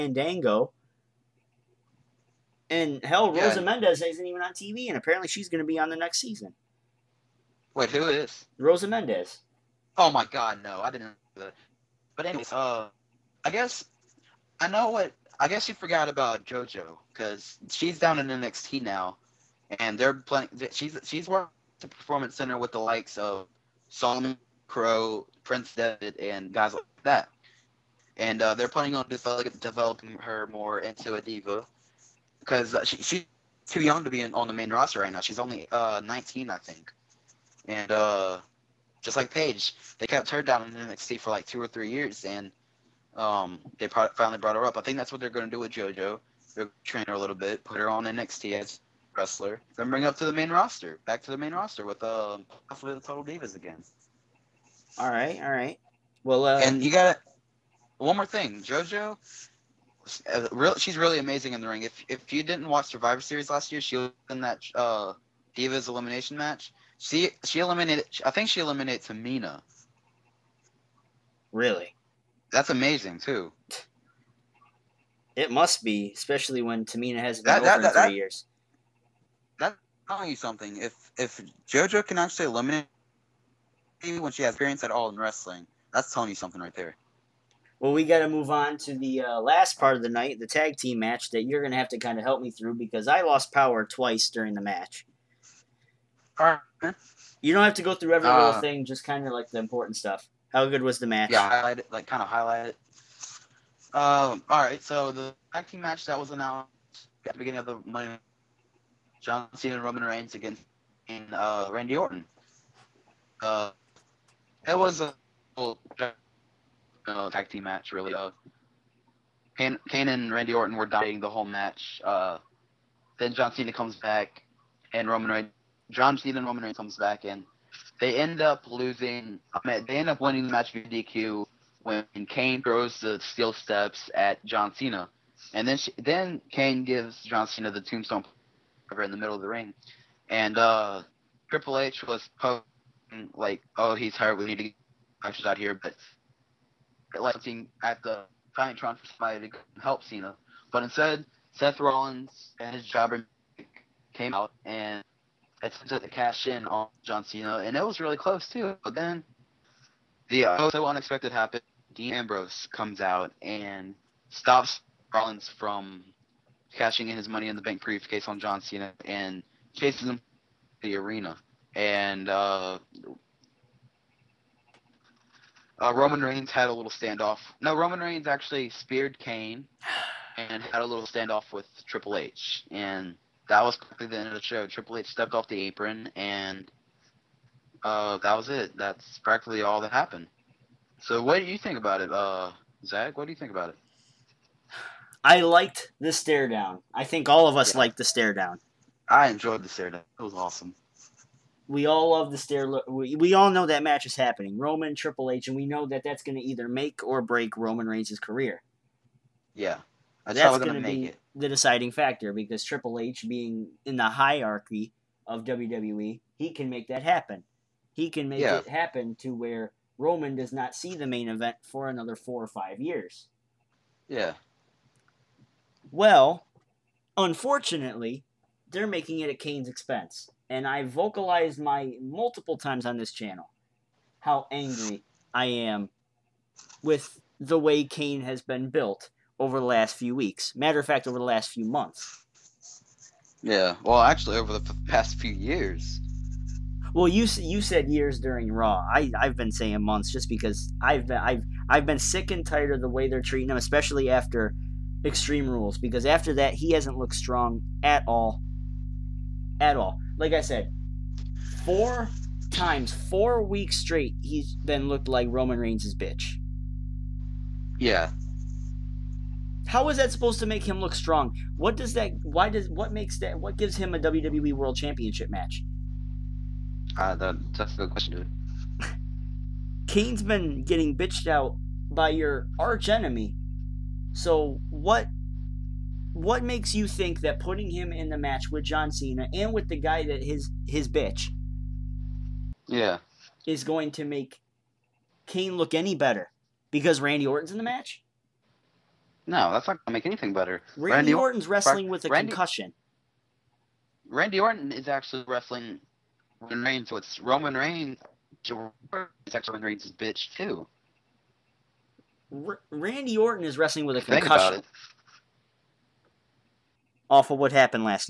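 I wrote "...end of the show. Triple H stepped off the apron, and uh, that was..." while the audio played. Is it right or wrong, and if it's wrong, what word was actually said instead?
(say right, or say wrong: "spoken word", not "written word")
right.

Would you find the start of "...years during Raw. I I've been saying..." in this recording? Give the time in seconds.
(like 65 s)
247 s.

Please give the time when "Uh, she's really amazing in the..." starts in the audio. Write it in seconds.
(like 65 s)
60 s.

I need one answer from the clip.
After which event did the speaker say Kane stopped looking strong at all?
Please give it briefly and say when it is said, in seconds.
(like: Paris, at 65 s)
Extreme Rules, at 255 s.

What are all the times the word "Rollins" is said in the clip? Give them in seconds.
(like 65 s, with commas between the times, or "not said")
151 s, 165 s.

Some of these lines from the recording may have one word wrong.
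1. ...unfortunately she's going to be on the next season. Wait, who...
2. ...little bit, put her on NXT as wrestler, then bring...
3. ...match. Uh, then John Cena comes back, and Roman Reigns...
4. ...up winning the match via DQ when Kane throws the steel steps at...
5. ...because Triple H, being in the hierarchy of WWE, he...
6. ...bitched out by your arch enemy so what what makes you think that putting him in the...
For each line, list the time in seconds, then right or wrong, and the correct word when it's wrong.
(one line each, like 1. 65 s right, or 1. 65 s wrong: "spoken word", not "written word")
1. 4 s wrong: "apparently", not "unfortunately"
2. 47 s right
3. 121 s right
4. 130 s right
5. 212 s right
6. 280 s right.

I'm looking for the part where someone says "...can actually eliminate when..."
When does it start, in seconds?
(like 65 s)
82 s.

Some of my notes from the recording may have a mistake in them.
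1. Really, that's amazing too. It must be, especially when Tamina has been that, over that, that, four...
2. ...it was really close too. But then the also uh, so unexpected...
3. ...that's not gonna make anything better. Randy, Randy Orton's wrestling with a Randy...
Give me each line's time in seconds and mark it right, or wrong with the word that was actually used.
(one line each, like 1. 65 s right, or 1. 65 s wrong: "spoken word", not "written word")
1. 71 s wrong: "three", not "four"
2. 157 s right
3. 299 s right.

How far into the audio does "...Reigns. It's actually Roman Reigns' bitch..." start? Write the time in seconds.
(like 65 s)
307 s.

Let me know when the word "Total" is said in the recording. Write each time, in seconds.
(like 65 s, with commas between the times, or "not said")
53 s.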